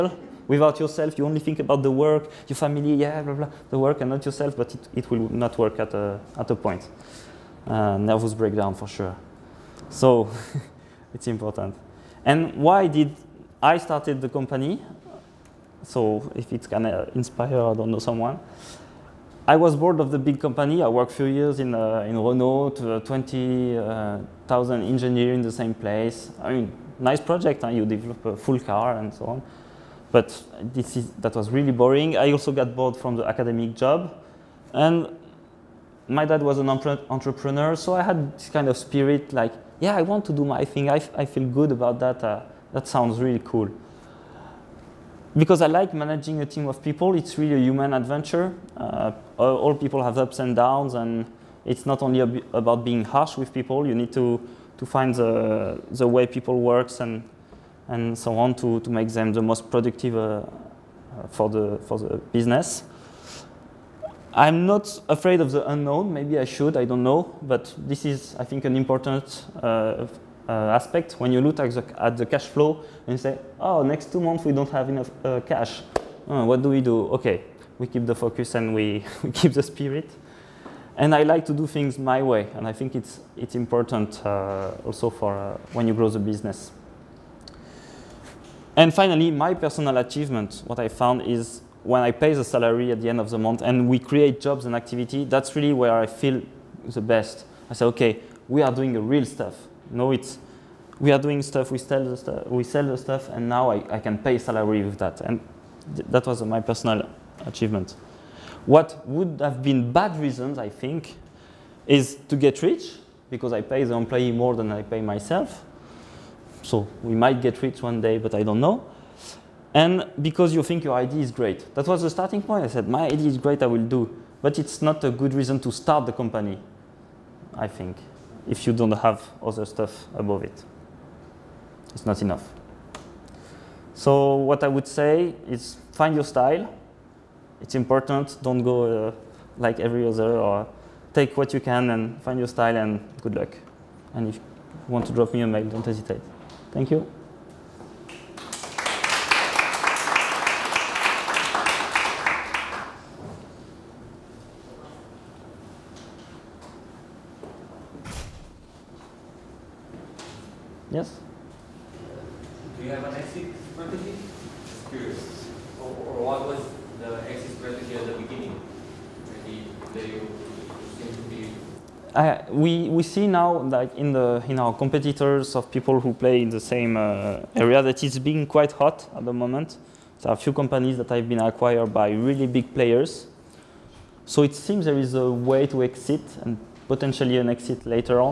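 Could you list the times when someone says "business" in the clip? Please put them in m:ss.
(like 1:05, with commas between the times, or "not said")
1:02, 1:26.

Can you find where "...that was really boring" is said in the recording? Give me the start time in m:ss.
0:31.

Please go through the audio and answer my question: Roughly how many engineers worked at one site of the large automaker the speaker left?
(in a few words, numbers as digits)
20,000.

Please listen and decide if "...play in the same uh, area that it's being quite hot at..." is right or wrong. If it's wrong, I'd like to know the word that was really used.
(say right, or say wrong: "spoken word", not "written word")
right.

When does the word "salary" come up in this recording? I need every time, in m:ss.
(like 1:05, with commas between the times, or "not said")
1:32, 1:44.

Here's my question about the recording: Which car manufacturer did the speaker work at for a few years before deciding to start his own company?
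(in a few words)
Renault.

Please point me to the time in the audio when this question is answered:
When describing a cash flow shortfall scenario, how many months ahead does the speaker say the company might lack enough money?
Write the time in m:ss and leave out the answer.
1:14.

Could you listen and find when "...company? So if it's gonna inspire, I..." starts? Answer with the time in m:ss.
0:14.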